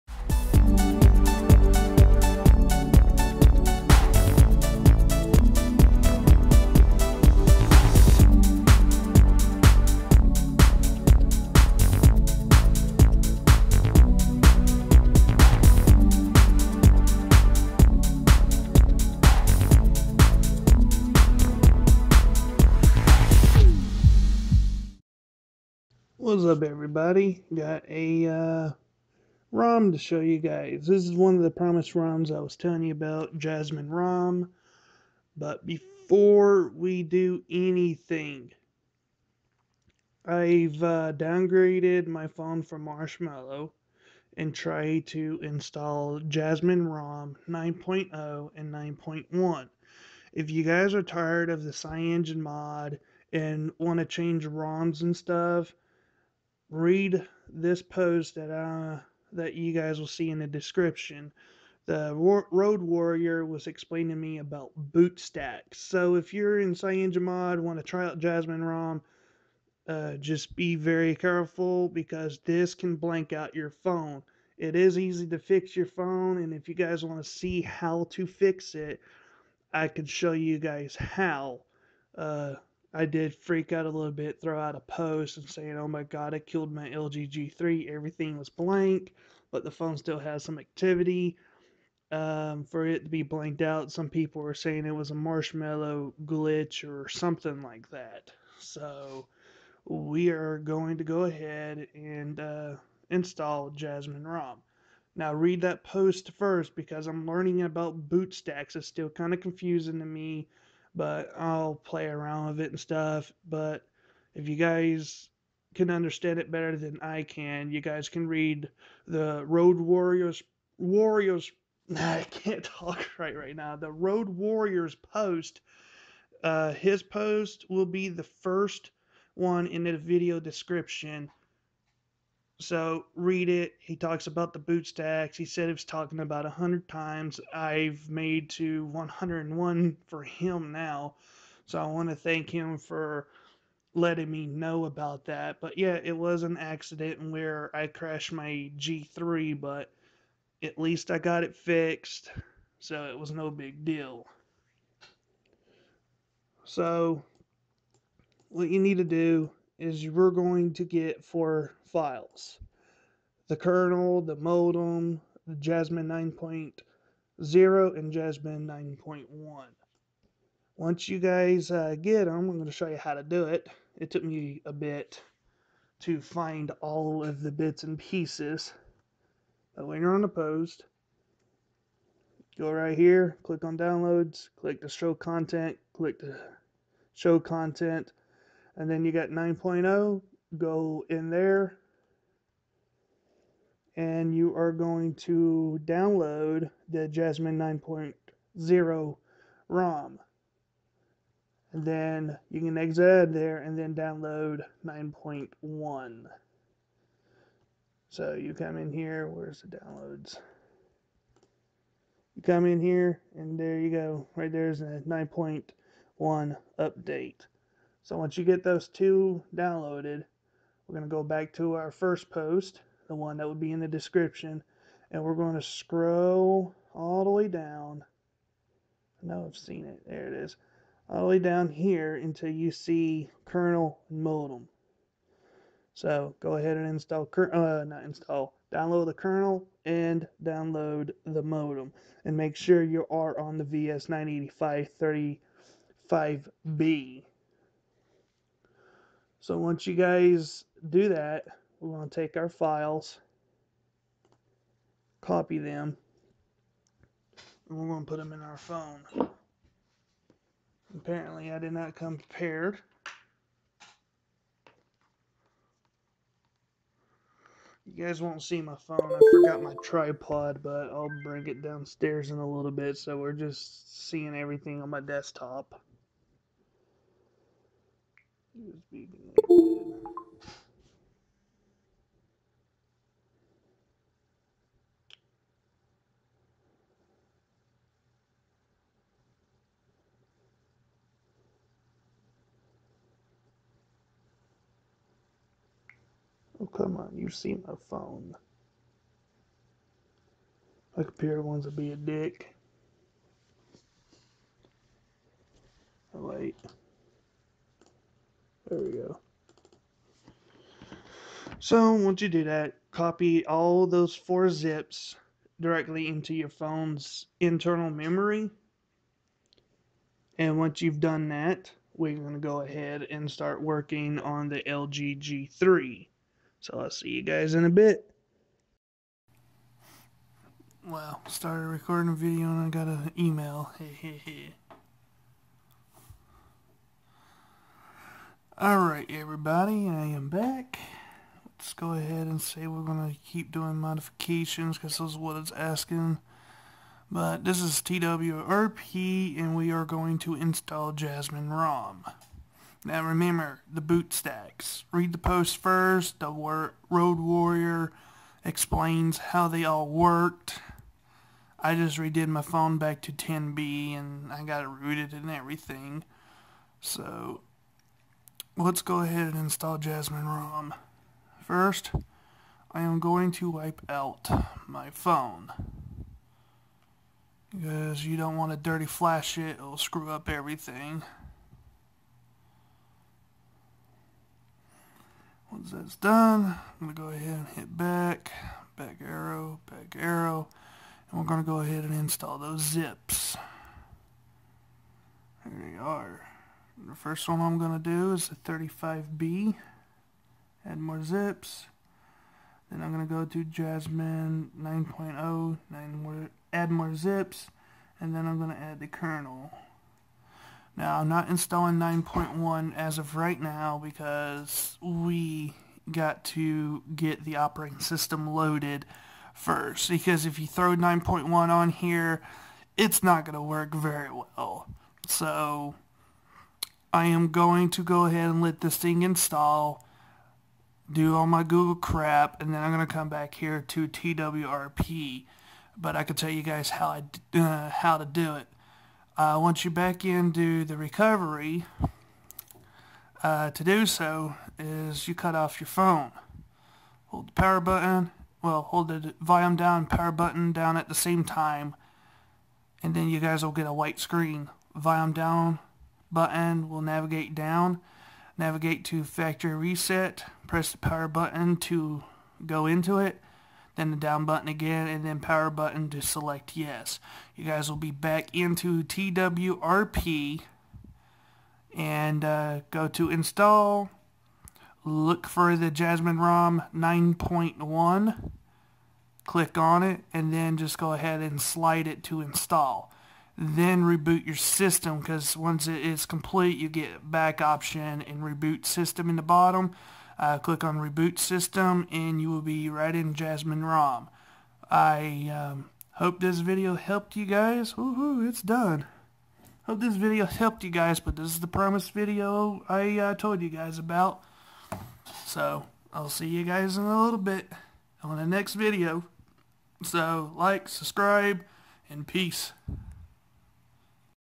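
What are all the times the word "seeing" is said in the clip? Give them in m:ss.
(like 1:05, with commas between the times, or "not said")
4:34.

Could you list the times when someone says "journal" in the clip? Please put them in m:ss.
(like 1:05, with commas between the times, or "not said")
not said.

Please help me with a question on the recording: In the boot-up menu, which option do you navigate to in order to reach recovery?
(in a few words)
factory reset.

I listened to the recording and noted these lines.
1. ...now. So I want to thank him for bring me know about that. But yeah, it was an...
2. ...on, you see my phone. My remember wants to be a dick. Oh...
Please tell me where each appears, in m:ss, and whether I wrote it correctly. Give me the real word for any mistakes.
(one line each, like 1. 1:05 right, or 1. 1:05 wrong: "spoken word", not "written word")
1. 2:20 wrong: "letting", not "bring"
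2. 4:56 wrong: "computer", not "remember".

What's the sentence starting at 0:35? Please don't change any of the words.
But before we do anything, I've uh, downgraded my phone from Marshmallow and tried to install Jasmine ROM 9.0 and 9.1.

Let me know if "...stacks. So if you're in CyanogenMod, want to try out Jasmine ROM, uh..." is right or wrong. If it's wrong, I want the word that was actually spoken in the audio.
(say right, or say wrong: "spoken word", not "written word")
right.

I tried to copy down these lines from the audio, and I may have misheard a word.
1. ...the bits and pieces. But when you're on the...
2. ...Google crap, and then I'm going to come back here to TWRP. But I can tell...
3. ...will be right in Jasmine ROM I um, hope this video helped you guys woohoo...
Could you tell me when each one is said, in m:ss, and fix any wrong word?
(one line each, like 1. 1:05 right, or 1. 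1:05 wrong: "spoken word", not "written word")
1. 2:57 right
2. 7:11 right
3. 8:12 right.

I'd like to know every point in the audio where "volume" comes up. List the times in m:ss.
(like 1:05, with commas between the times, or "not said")
7:29, 7:34.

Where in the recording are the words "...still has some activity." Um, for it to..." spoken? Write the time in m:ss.
1:29.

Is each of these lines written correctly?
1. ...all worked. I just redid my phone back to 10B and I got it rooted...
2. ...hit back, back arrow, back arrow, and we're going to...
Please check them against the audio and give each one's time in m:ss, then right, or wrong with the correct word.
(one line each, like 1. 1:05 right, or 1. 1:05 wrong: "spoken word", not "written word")
1. 5:59 right
2. 6:27 right.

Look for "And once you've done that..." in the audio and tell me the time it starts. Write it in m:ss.
5:20.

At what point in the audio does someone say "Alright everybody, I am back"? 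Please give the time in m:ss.
5:38.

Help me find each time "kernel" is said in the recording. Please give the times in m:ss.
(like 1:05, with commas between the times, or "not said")
2:43, 3:53, 3:59, 6:48.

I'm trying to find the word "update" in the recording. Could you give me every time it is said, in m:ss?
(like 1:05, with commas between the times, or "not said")
3:36.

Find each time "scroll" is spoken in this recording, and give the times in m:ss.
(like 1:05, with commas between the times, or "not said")
3:45.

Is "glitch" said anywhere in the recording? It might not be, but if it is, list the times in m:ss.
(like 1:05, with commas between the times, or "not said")
1:36.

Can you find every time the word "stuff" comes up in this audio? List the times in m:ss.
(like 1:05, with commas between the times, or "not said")
0:55, 1:52.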